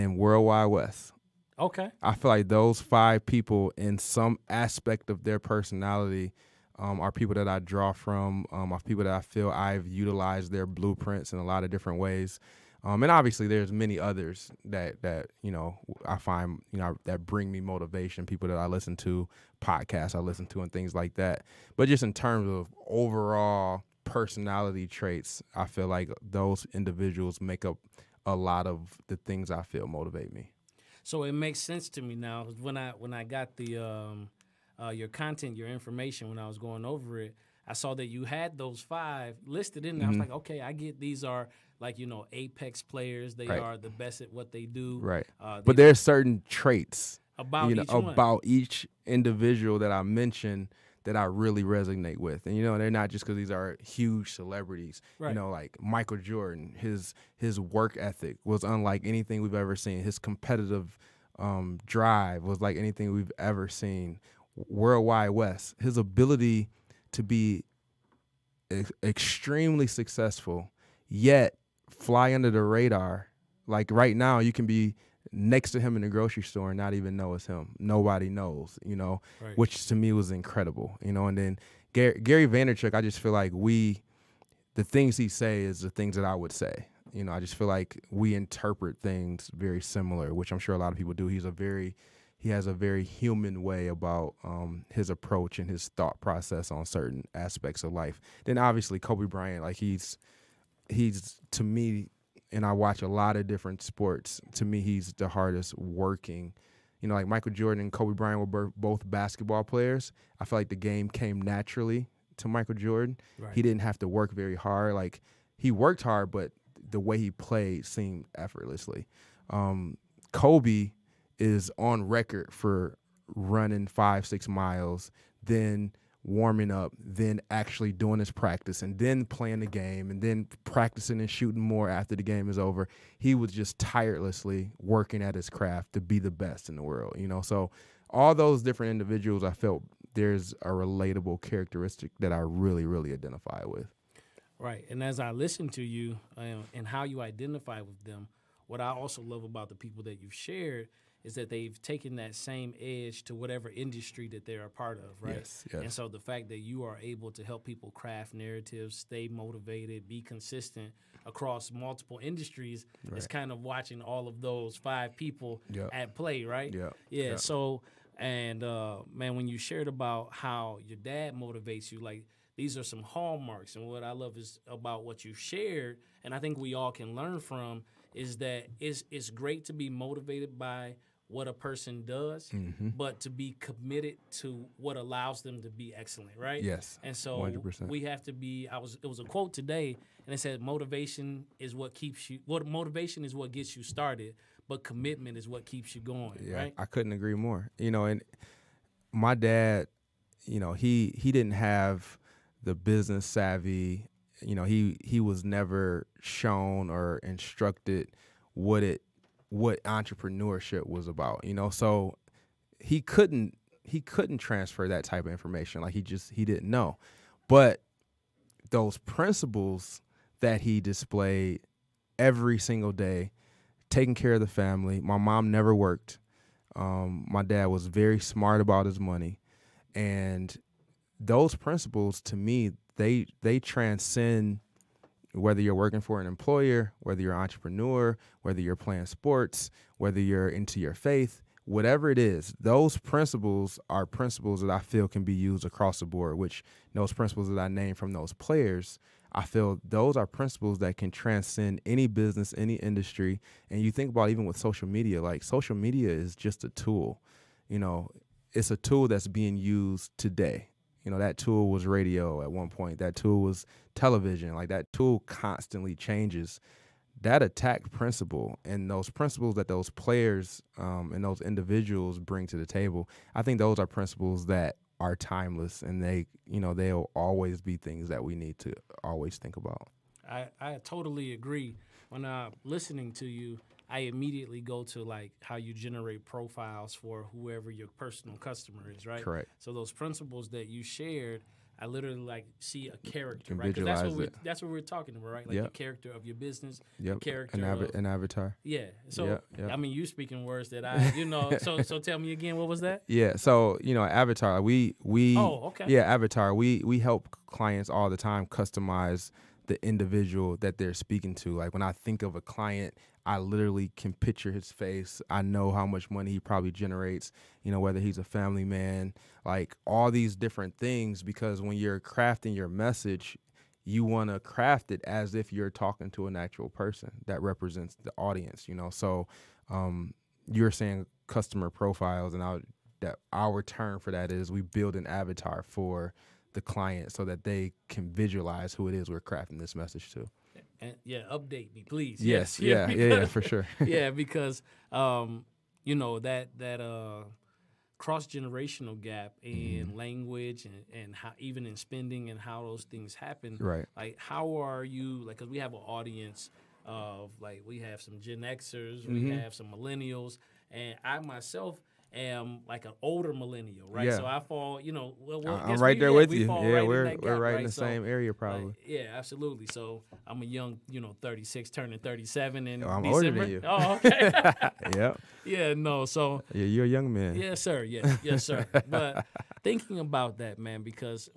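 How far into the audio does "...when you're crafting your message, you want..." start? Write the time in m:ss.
5:21.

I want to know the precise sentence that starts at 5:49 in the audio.
language and and how even in spending and how those things happen.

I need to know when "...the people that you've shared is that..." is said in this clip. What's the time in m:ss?
2:29.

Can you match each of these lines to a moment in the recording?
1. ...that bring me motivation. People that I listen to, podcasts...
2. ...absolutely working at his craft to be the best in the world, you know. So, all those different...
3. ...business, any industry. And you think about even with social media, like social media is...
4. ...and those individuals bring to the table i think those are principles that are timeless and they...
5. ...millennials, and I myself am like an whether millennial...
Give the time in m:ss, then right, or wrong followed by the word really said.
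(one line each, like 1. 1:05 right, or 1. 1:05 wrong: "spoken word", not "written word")
1. 0:17 right
2. 2:13 wrong: "tirelessly", not "absolutely"
3. 4:12 right
4. 4:31 right
5. 5:59 wrong: "older", not "whether".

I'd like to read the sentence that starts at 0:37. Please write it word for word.
I saw that you had those five listed in there.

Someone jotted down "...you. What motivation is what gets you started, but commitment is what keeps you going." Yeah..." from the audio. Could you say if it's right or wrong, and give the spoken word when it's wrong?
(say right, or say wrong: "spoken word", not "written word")
right.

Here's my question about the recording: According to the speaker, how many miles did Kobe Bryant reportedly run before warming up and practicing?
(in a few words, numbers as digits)
5 or 6.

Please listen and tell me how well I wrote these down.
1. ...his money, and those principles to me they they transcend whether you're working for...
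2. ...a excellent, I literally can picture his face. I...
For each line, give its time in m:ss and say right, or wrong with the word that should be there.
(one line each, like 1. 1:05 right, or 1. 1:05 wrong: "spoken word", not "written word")
1. 3:48 right
2. 5:12 wrong: "client", not "excellent".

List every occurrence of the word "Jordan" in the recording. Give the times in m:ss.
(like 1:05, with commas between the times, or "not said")
0:56, 1:47, 1:52.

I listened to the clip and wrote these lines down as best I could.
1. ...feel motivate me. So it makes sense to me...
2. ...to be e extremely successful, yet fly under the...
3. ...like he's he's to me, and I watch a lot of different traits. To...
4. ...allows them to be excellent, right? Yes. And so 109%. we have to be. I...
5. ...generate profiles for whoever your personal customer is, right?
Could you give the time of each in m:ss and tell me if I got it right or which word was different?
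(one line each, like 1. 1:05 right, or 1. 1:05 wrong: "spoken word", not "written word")
1. 0:29 right
2. 1:07 right
3. 1:39 wrong: "sports", not "traits"
4. 3:04 wrong: "100", not "109"
5. 4:45 right.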